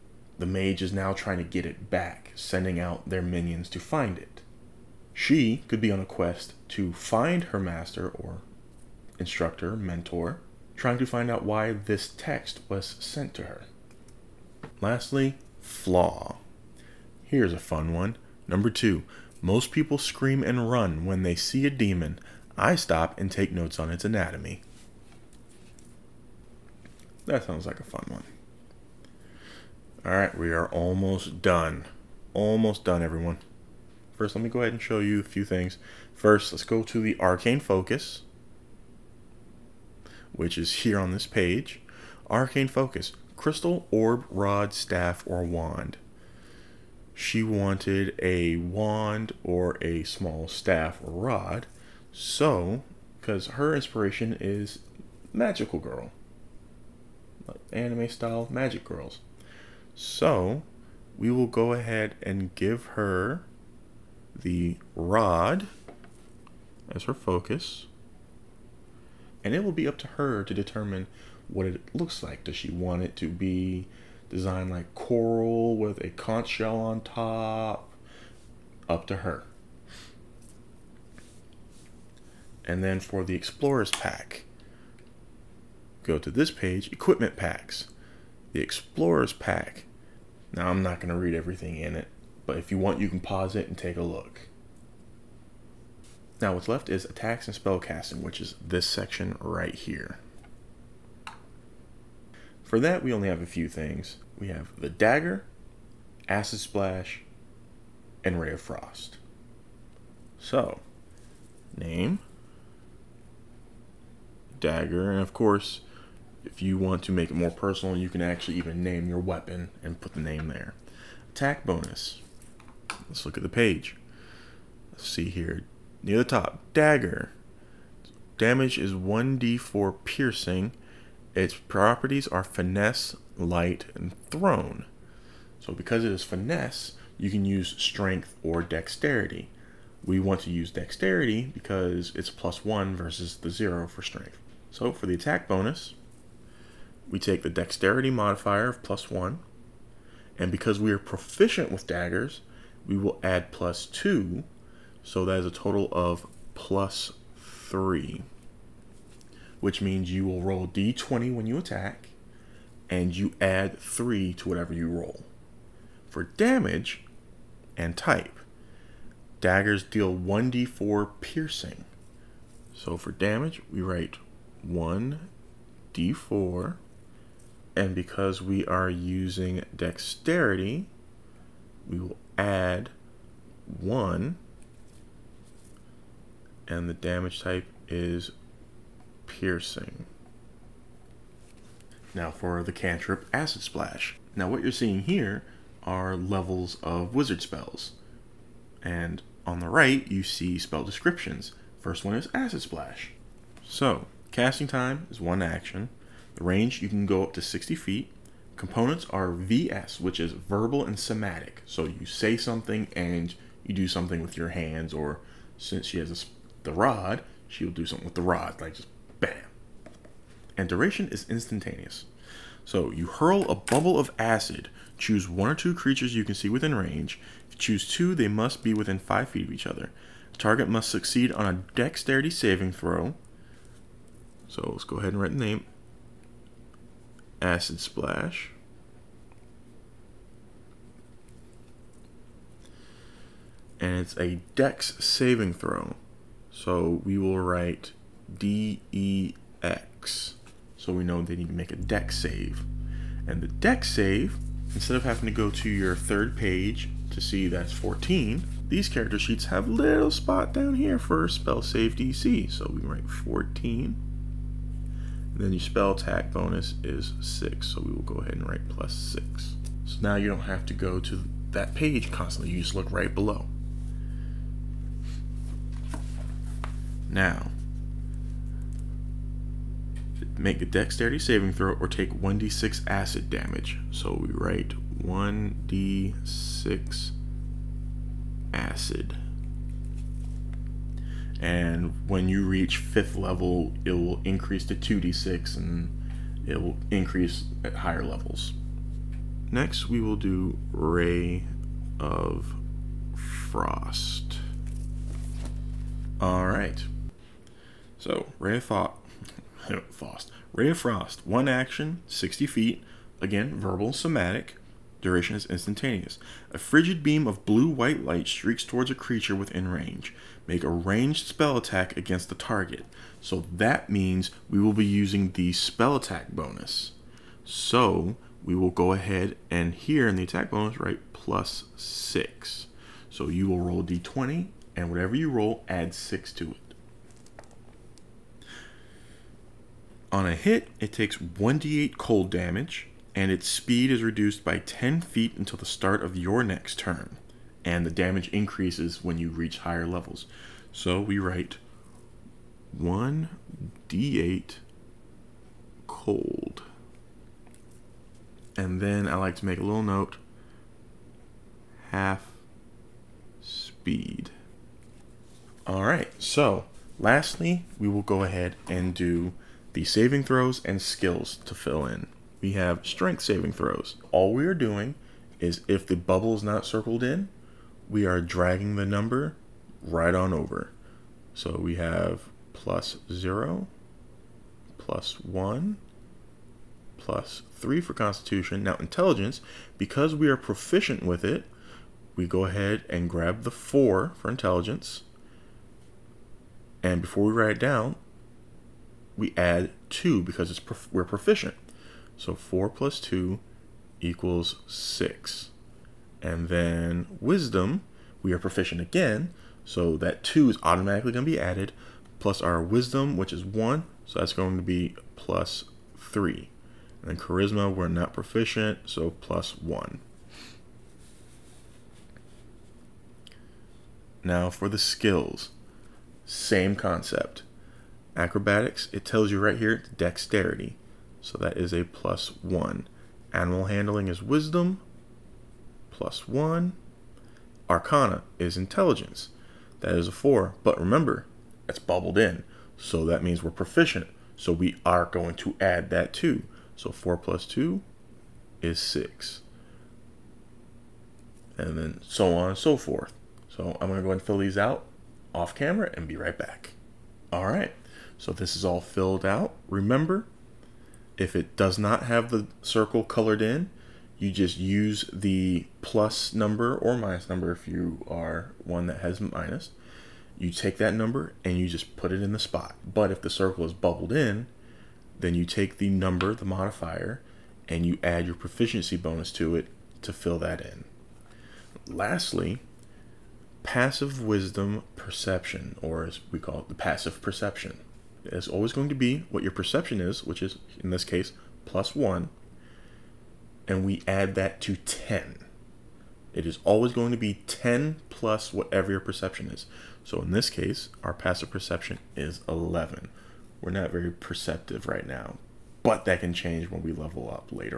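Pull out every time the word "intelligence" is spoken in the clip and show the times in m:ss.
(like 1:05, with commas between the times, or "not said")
6:28, 6:34, 7:18.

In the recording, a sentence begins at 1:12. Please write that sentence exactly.
Does she want it to be designed like coral with a conch shell on top.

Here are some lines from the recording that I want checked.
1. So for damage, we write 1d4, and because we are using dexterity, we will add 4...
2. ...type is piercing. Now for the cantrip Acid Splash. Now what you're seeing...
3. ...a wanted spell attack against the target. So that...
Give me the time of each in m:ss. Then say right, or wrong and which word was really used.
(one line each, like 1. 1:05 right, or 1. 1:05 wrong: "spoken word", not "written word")
1. 2:52 wrong: "1", not "4"
2. 3:07 right
3. 5:20 wrong: "ranged", not "wanted".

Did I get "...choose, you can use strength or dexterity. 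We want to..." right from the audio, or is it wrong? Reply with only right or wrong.
wrong.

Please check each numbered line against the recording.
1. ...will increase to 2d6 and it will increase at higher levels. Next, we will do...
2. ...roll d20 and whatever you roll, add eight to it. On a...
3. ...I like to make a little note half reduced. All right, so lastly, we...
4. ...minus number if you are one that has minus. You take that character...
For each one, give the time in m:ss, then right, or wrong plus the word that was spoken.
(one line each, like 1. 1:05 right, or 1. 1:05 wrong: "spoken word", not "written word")
1. 4:53 right
2. 5:33 wrong: "six", not "eight"
3. 5:59 wrong: "speed", not "reduced"
4. 7:46 wrong: "number", not "character".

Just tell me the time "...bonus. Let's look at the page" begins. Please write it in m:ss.
2:01.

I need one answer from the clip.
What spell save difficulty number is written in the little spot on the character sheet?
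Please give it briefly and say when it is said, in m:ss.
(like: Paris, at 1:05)
14, at 4:22.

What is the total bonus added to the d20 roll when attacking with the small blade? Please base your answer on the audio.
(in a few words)
+3.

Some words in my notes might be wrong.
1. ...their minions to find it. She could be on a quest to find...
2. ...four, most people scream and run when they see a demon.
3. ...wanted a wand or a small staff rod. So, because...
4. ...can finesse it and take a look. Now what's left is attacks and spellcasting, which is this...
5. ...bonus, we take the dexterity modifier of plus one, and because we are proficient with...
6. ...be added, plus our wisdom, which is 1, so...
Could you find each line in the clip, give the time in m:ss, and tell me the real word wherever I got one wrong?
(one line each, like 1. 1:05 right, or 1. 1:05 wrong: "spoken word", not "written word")
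1. 0:03 right
2. 0:18 wrong: "two", not "four"
3. 0:47 right
4. 1:33 wrong: "pause", not "finesse"
5. 2:25 right
6. 6:51 right.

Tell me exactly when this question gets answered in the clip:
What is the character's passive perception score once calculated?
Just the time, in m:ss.
8:21.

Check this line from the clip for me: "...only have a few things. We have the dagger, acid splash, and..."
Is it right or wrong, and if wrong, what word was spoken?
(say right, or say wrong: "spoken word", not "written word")
right.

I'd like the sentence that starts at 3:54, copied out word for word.
So let's go ahead and write the name.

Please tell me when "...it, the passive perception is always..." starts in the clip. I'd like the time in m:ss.
8:06.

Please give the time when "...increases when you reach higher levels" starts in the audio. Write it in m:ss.
5:48.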